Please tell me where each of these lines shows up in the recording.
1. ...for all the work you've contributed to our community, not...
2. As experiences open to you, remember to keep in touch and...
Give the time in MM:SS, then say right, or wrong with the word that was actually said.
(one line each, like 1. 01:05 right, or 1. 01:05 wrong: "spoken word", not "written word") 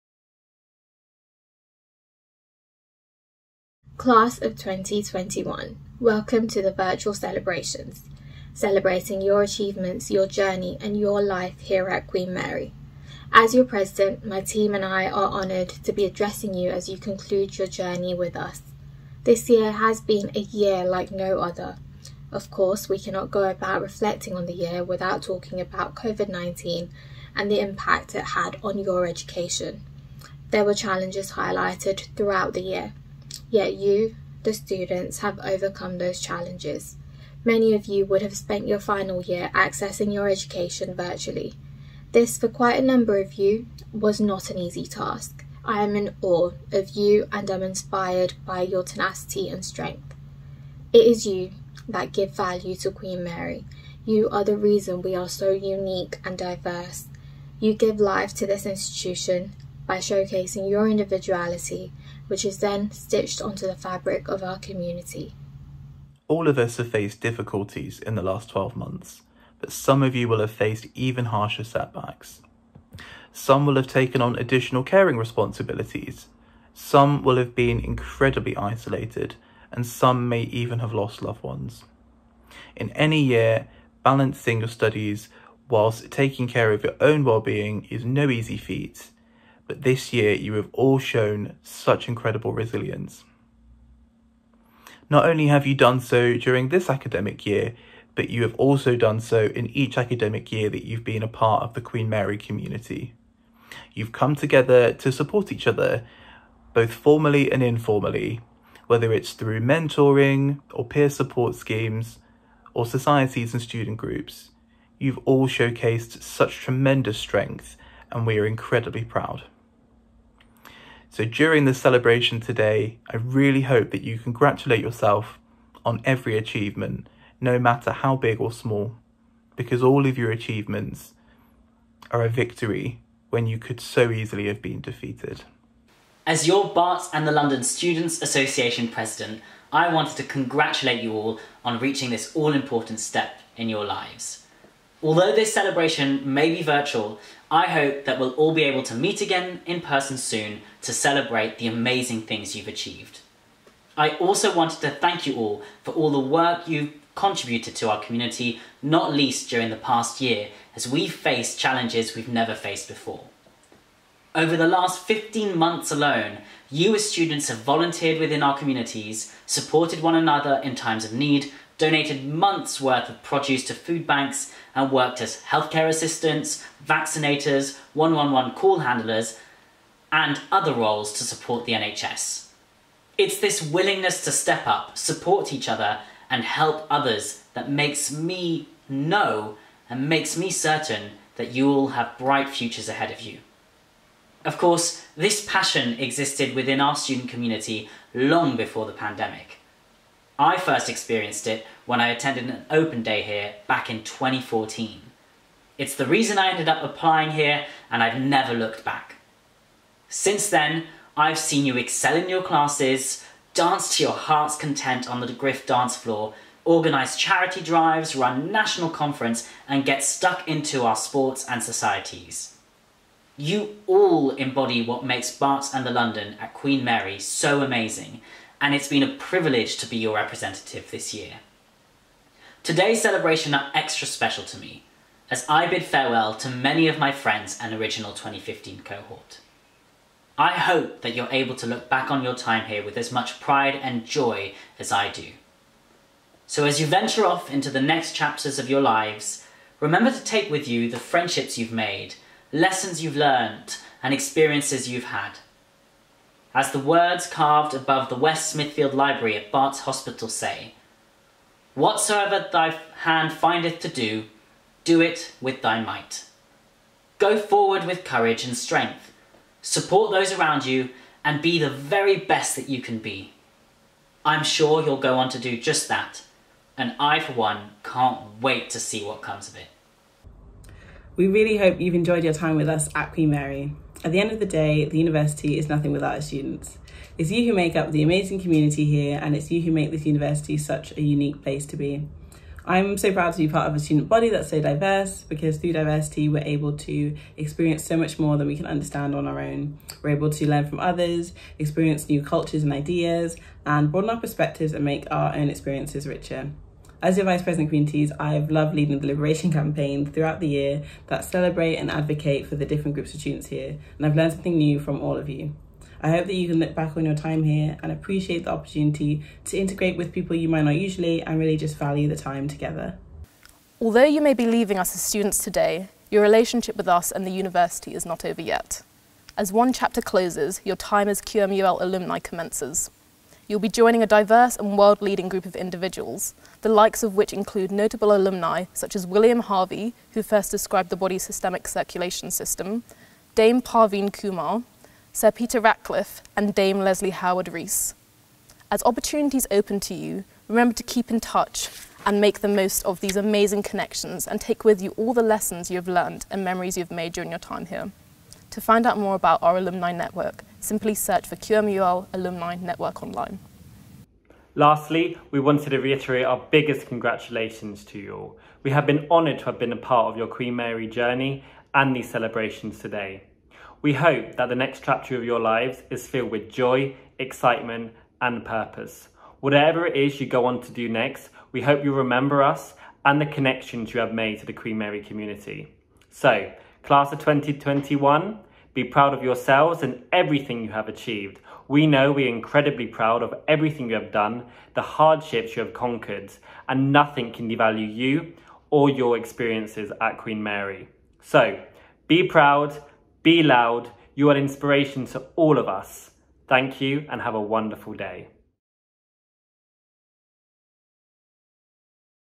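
1. 02:35 right
2. 05:48 wrong: "opportunities", not "experiences".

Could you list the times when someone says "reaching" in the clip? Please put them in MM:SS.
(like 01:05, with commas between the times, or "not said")
02:21.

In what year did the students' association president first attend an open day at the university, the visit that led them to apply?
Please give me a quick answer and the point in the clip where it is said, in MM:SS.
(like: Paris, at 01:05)
2014, at 03:24.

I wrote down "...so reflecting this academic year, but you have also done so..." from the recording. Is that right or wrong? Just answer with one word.
wrong.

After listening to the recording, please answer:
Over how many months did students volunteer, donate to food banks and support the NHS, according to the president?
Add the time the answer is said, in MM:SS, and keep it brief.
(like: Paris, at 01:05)
15, at 02:45.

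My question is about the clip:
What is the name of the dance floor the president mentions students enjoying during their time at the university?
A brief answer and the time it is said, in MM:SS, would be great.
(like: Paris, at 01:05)
Griff, at 03:35.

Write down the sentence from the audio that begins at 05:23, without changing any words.
Although you may be leaving us as students today, your relationship with us and the university is not over yet.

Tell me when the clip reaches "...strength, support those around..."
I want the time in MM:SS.
04:28.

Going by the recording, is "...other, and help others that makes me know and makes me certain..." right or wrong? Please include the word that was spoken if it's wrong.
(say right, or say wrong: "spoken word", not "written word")
right.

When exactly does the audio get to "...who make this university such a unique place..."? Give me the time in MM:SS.
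04:49.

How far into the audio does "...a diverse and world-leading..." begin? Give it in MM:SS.
05:34.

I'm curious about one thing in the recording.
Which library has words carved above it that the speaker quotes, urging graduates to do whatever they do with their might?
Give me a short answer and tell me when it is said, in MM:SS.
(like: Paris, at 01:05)
West Smithfield Library, at 04:18.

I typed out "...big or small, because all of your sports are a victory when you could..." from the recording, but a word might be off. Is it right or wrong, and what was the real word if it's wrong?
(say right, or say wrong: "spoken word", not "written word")
wrong: "achievements", not "sports".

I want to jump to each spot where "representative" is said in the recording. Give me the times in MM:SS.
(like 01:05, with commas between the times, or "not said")
03:50.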